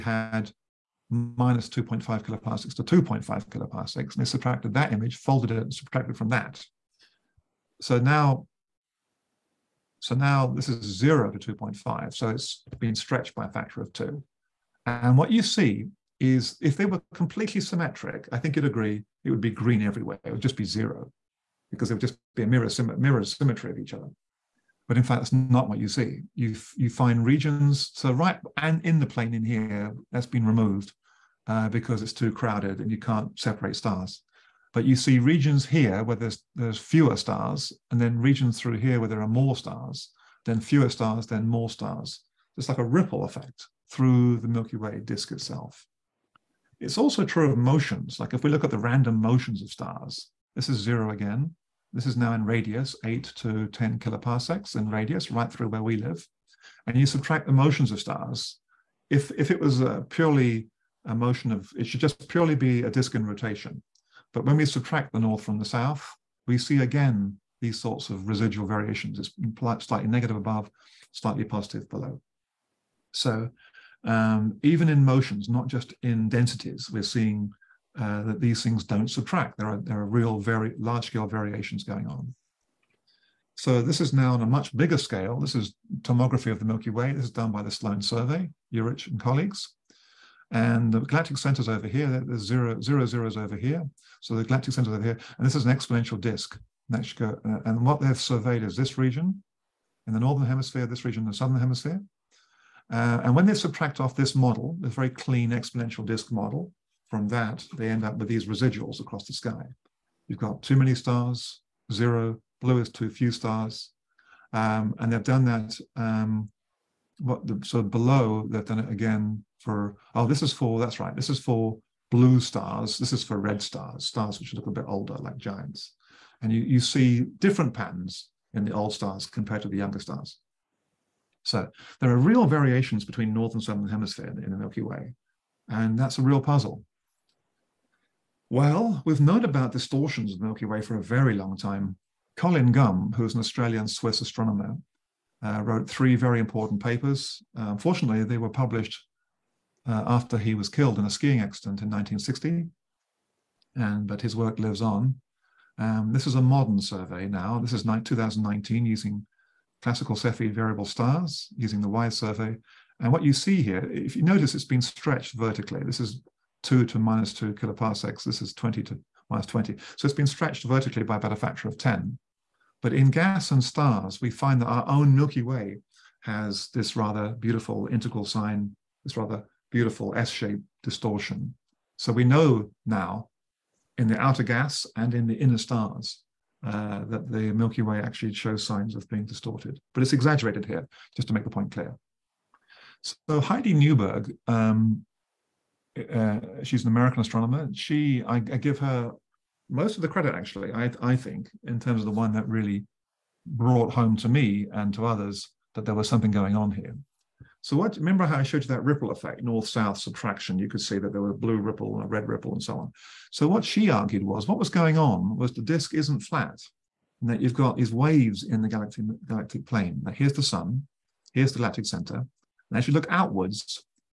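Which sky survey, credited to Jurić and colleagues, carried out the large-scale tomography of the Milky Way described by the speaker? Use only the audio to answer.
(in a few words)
Sloan Survey.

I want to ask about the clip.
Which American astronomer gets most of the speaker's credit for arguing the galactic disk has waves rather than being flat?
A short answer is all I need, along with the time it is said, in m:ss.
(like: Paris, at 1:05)
Heidi Newberg, at 3:13.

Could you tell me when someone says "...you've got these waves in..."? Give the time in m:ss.
3:37.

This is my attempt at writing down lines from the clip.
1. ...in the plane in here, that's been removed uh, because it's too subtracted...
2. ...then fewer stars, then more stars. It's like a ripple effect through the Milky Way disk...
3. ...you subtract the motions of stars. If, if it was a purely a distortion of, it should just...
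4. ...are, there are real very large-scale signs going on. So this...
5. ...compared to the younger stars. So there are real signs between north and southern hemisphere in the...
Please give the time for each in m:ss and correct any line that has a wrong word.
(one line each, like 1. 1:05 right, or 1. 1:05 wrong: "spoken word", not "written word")
1. 0:28 wrong: "crowded", not "subtracted"
2. 0:40 right
3. 0:56 wrong: "motion", not "distortion"
4. 1:19 wrong: "variations", not "signs"
5. 2:09 wrong: "variations", not "signs".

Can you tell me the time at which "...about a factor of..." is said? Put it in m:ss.
2:51.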